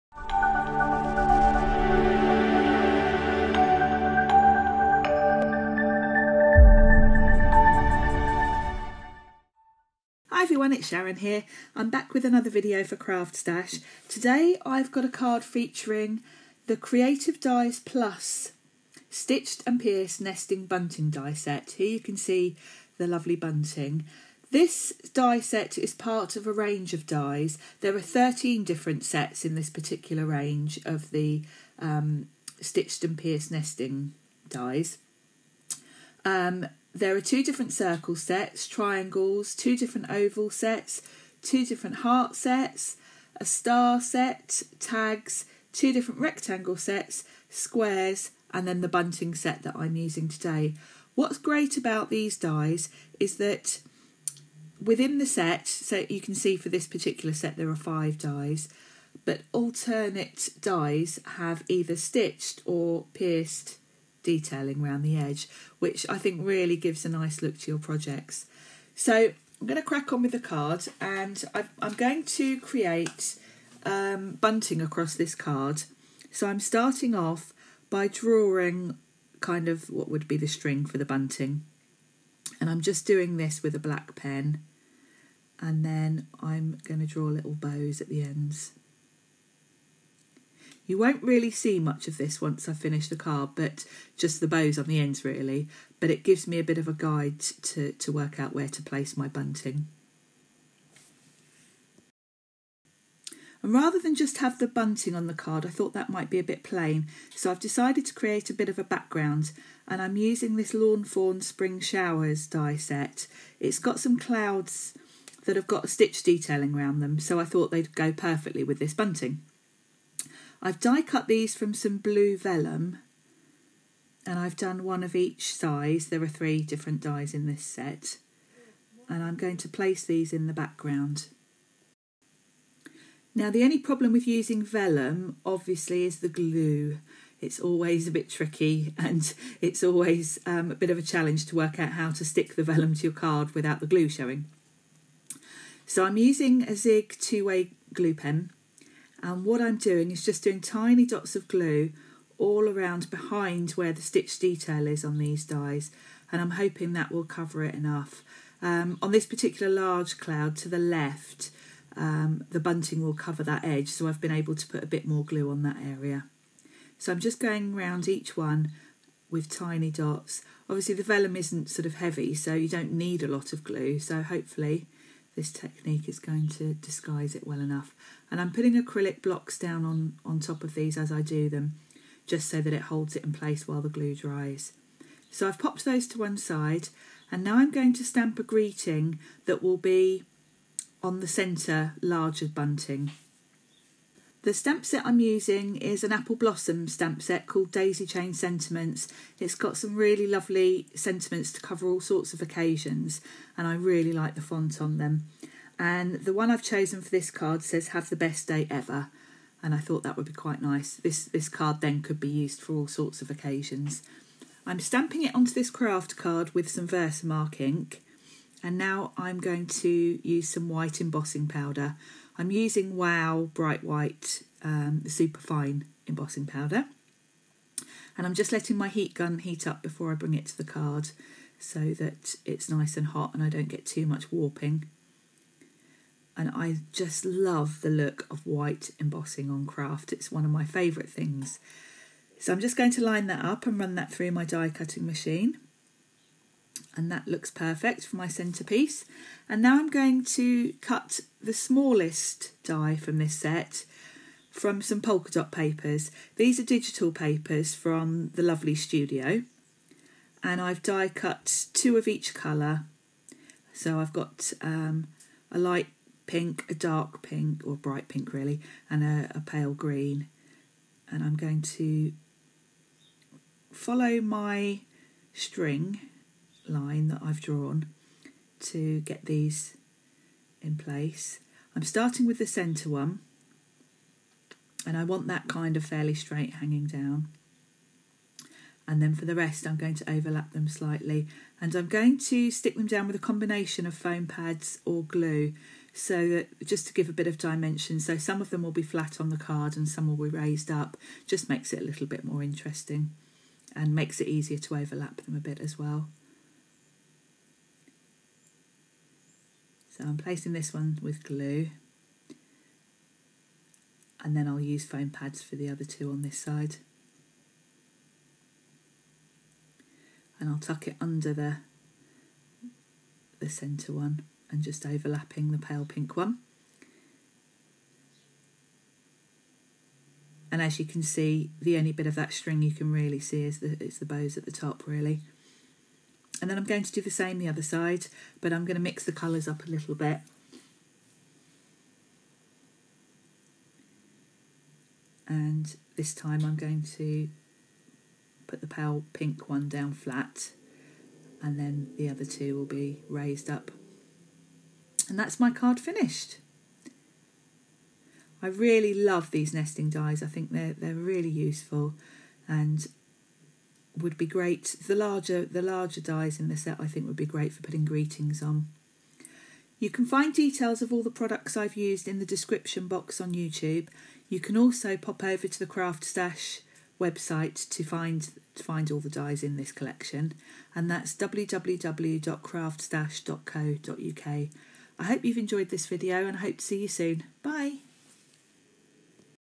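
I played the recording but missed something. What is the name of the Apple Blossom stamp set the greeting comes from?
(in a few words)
Daisy Chain Sentiments.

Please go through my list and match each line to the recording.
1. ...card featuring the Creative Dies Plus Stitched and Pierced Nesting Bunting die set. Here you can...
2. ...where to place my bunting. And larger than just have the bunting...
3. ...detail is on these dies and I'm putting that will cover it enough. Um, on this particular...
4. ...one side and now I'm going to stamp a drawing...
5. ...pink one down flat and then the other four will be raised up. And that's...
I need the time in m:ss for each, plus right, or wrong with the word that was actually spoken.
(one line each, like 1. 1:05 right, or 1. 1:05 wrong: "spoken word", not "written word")
1. 0:15 right
2. 1:38 wrong: "rather", not "larger"
3. 2:34 wrong: "hoping", not "putting"
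4. 3:06 wrong: "greeting", not "drawing"
5. 5:49 wrong: "two", not "four".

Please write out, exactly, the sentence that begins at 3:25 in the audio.
And the one I've chosen for this card says, Have the best day ever.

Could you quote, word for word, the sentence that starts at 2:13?
Now the only problem with using vellum obviously is the glue.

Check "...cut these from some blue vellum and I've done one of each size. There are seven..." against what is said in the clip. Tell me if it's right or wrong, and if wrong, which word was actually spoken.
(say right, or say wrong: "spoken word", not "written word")
wrong: "three", not "seven".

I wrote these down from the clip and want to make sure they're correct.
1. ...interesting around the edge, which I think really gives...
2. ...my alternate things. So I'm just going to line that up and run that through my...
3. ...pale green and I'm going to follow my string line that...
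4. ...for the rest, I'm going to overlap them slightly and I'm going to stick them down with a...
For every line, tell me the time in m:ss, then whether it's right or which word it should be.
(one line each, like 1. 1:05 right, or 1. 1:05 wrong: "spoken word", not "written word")
1. 1:04 wrong: "detailing", not "interesting"
2. 4:00 wrong: "favourite", not "alternate"
3. 4:29 right
4. 4:49 right.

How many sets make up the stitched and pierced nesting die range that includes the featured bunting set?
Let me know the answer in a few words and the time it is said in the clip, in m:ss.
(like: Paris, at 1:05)
13, at 0:27.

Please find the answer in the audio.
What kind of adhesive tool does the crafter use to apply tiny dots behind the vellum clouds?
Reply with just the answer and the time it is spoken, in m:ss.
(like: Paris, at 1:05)
Zig two-way glue pen, at 2:26.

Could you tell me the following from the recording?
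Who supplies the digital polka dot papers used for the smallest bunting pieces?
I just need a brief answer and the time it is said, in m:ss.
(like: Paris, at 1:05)
The Lovely Studio, at 4:18.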